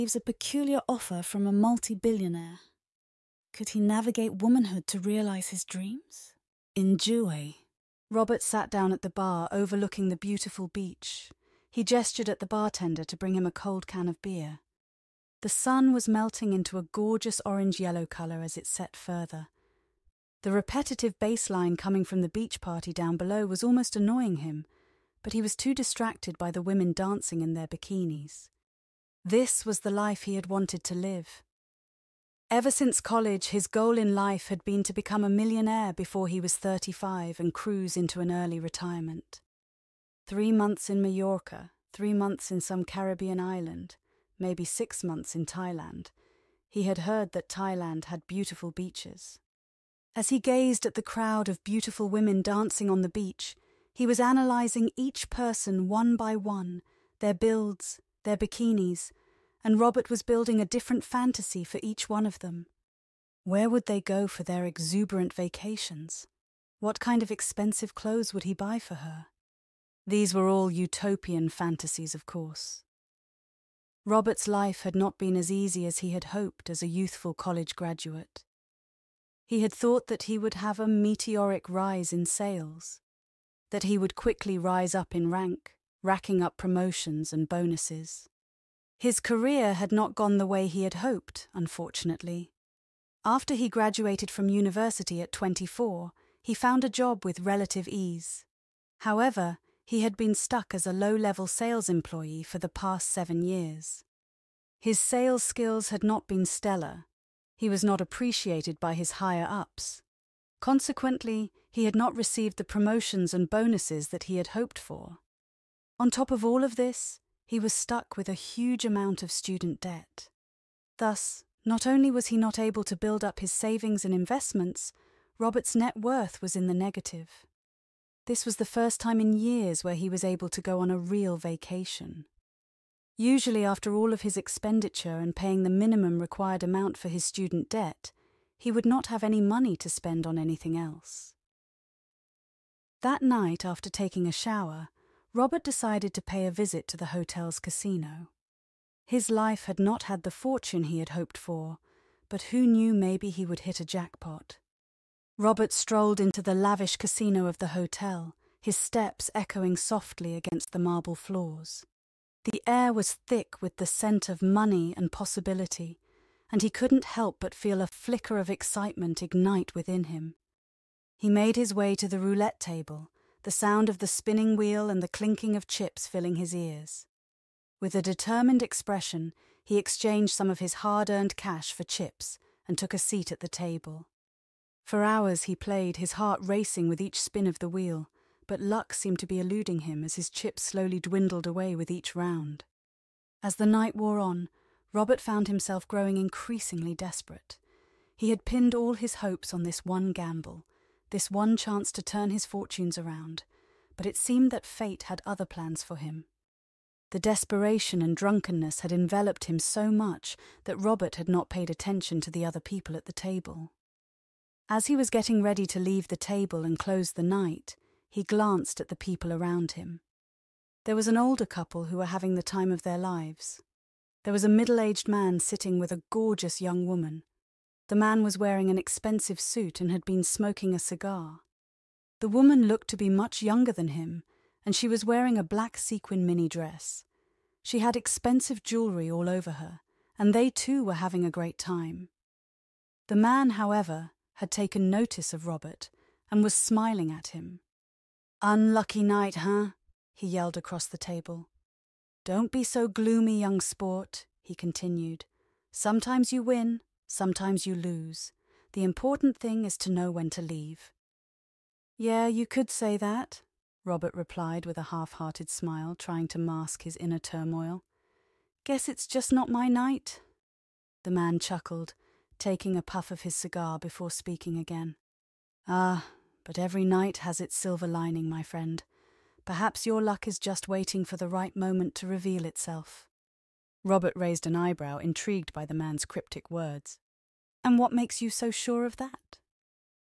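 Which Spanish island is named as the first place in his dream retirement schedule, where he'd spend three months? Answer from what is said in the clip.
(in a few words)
Mallorca.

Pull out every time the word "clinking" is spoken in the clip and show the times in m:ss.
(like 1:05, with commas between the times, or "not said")
2:55.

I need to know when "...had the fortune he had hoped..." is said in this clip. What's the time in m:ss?
2:30.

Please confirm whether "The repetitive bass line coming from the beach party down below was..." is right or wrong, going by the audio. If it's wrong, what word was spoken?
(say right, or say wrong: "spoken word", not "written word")
right.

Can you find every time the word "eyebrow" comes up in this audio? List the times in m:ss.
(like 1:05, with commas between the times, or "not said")
4:44.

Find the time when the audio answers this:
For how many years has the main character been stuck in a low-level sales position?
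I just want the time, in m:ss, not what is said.
1:43.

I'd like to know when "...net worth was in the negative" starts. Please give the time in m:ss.
2:05.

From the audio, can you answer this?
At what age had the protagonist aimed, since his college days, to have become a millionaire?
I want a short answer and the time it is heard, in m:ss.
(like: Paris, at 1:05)
35, at 0:36.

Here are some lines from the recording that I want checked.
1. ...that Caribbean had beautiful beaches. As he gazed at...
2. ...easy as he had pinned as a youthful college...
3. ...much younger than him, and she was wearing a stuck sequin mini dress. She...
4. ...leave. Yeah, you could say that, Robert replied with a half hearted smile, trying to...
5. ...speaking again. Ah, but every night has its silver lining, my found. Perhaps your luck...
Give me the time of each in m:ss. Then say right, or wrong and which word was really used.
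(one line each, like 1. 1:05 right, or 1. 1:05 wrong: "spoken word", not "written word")
1. 0:47 wrong: "Thailand", not "Caribbean"
2. 1:15 wrong: "hoped", not "pinned"
3. 3:53 wrong: "black", not "stuck"
4. 4:20 right
5. 4:34 wrong: "friend", not "found".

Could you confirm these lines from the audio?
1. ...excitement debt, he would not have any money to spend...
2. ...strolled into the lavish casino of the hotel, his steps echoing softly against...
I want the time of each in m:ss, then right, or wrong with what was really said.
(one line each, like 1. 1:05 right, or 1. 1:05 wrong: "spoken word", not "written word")
1. 2:17 wrong: "student", not "excitement"
2. 2:35 right.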